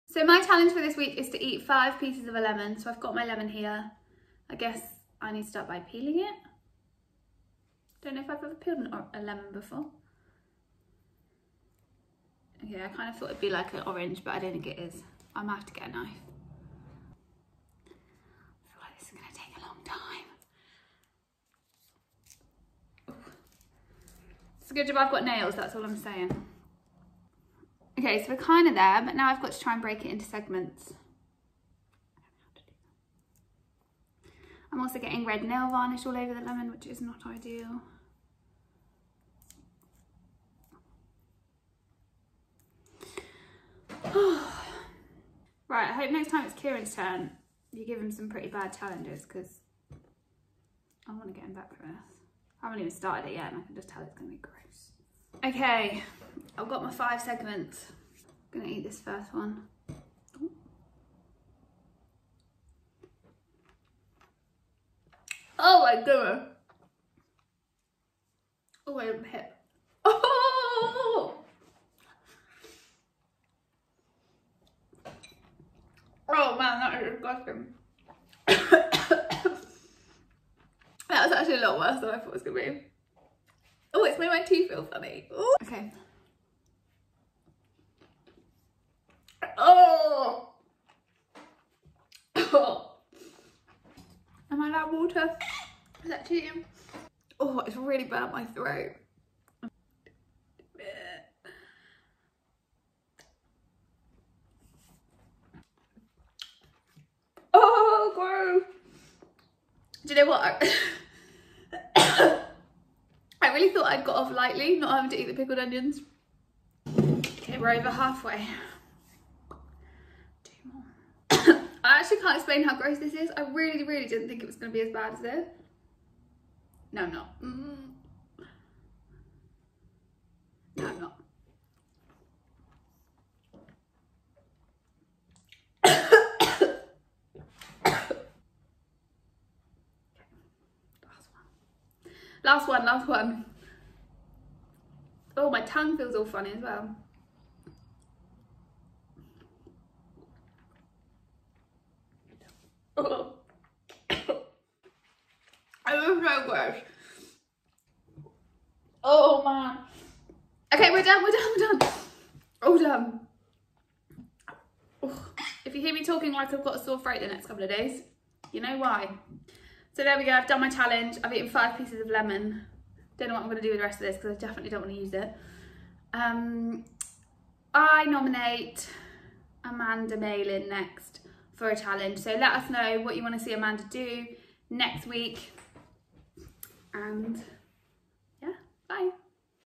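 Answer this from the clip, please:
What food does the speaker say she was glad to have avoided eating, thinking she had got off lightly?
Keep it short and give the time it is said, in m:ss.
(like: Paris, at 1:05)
Pickled onions, at 1:55.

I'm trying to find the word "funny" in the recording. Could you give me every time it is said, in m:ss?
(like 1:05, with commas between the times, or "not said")
1:24, 2:26.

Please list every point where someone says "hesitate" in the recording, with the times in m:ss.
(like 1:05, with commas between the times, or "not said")
not said.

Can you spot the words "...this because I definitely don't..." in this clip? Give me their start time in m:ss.
2:54.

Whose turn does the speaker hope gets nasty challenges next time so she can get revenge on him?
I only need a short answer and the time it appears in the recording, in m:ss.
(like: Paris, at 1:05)
Kieran, at 0:46.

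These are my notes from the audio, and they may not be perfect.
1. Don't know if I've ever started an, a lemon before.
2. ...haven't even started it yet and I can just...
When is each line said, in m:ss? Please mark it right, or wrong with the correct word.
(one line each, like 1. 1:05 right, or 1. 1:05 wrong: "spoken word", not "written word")
1. 0:08 wrong: "peeled", not "started"
2. 0:52 right.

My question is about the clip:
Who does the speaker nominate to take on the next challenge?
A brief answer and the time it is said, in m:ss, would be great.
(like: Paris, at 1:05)
Amanda Malin, at 2:59.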